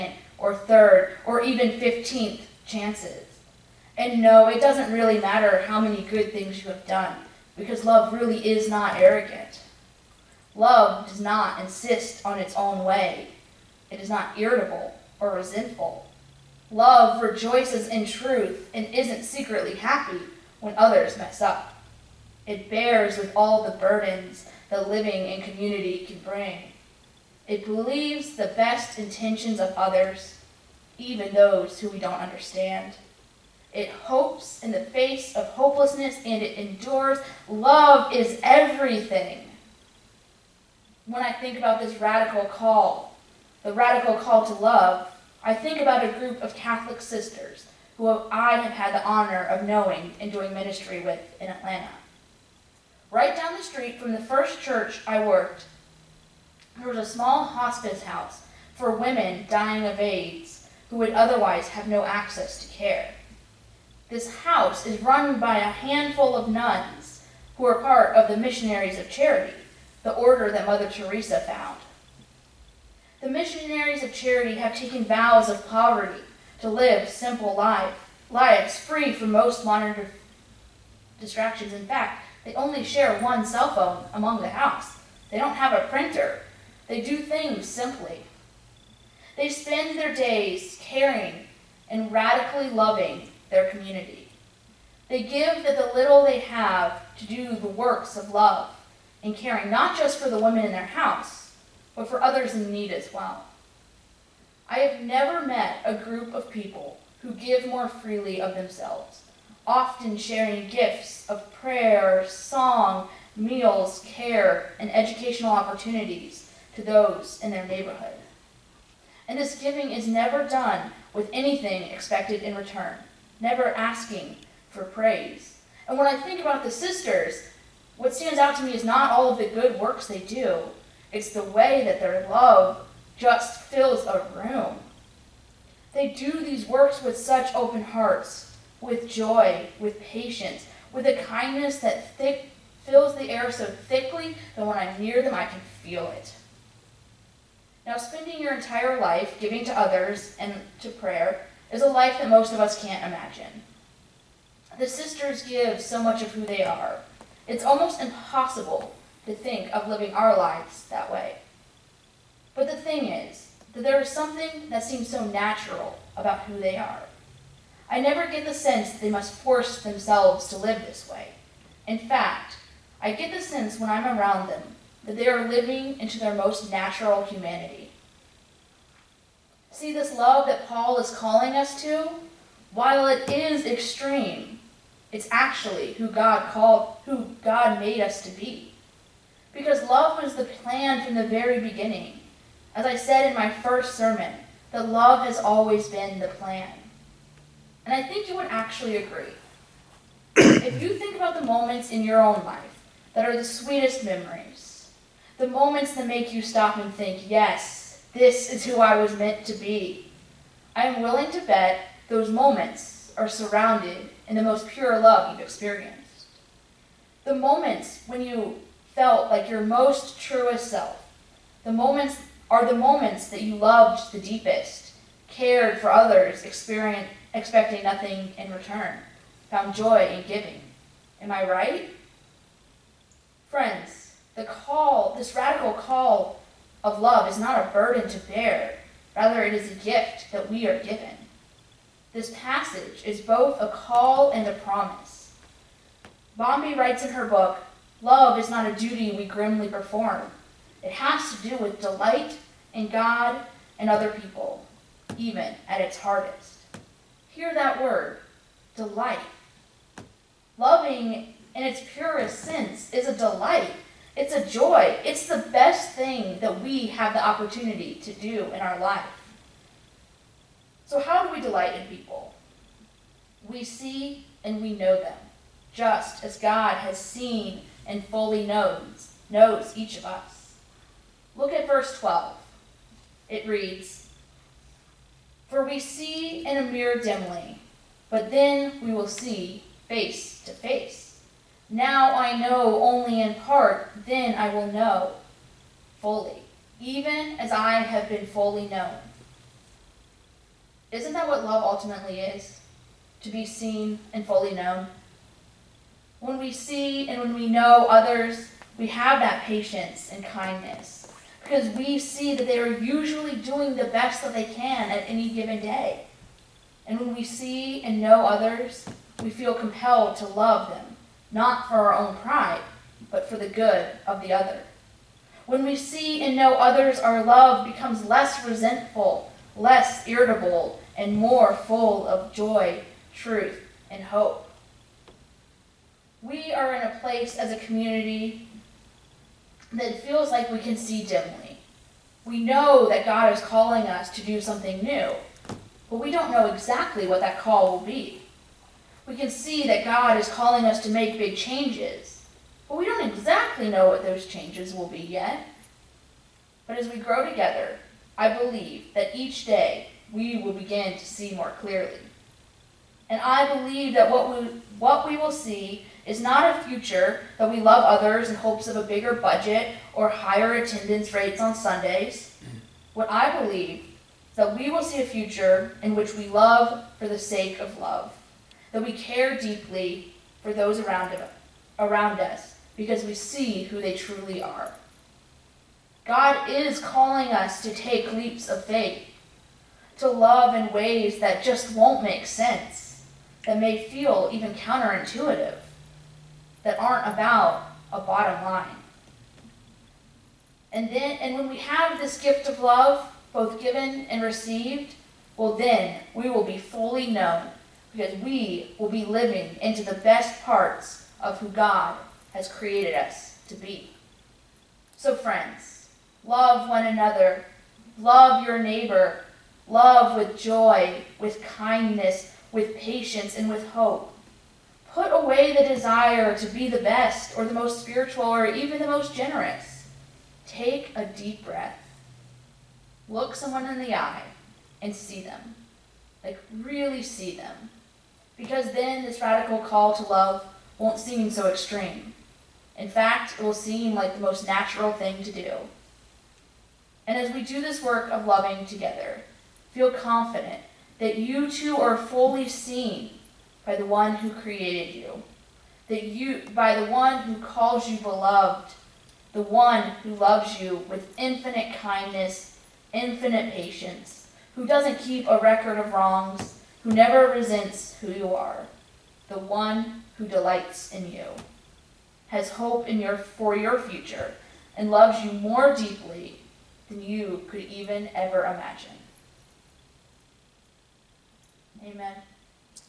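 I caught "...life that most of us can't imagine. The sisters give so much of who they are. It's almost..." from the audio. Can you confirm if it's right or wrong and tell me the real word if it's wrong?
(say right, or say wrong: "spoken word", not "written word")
right.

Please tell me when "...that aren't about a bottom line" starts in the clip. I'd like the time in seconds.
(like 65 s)
396 s.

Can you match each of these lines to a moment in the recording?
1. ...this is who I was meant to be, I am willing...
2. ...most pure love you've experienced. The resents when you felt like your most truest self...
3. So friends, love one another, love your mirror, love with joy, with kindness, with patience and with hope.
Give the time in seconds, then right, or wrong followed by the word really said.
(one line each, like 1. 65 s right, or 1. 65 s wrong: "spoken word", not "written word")
1. 208 s right
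2. 214 s wrong: "moments", not "resents"
3. 414 s wrong: "neighbor", not "mirror".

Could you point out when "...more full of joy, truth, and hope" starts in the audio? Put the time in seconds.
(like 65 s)
331 s.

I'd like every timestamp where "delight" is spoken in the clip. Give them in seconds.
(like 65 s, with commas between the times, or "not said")
251 s, 258 s, 263 s, 271 s, 470 s.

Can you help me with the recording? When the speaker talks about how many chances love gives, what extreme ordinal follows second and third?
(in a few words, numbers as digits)
15th.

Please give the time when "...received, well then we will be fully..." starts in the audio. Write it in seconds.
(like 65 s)
404 s.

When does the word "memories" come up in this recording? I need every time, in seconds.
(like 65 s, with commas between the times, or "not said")
204 s.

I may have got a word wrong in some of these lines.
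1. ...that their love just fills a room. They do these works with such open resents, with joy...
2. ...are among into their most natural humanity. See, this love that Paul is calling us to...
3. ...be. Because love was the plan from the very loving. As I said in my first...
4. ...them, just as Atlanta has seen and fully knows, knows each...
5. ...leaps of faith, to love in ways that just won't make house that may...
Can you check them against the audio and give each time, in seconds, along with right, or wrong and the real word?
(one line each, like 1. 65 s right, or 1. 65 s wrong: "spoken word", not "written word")
1. 131 s wrong: "hearts", not "resents"
2. 175 s wrong: "living", not "among"
3. 188 s wrong: "beginning", not "loving"
4. 274 s wrong: "God", not "Atlanta"
5. 388 s wrong: "sense", not "house".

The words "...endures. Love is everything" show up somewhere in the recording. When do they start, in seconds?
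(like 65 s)
36 s.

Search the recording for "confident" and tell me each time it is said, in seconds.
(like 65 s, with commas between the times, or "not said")
449 s.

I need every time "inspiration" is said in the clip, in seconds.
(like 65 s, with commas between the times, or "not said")
not said.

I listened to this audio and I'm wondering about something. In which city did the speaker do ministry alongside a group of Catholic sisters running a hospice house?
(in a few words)
Atlanta.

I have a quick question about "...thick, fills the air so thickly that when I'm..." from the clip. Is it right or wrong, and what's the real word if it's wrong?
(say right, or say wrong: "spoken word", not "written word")
right.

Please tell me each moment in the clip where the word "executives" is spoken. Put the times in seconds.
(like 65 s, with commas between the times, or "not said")
not said.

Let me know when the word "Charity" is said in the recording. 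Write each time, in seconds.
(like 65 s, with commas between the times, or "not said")
69 s, 74 s.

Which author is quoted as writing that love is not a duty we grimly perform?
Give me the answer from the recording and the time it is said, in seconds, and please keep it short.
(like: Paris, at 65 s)
Bondi, at 246 s.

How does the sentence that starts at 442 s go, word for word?
In fact, it will seem like the most natural thing to do.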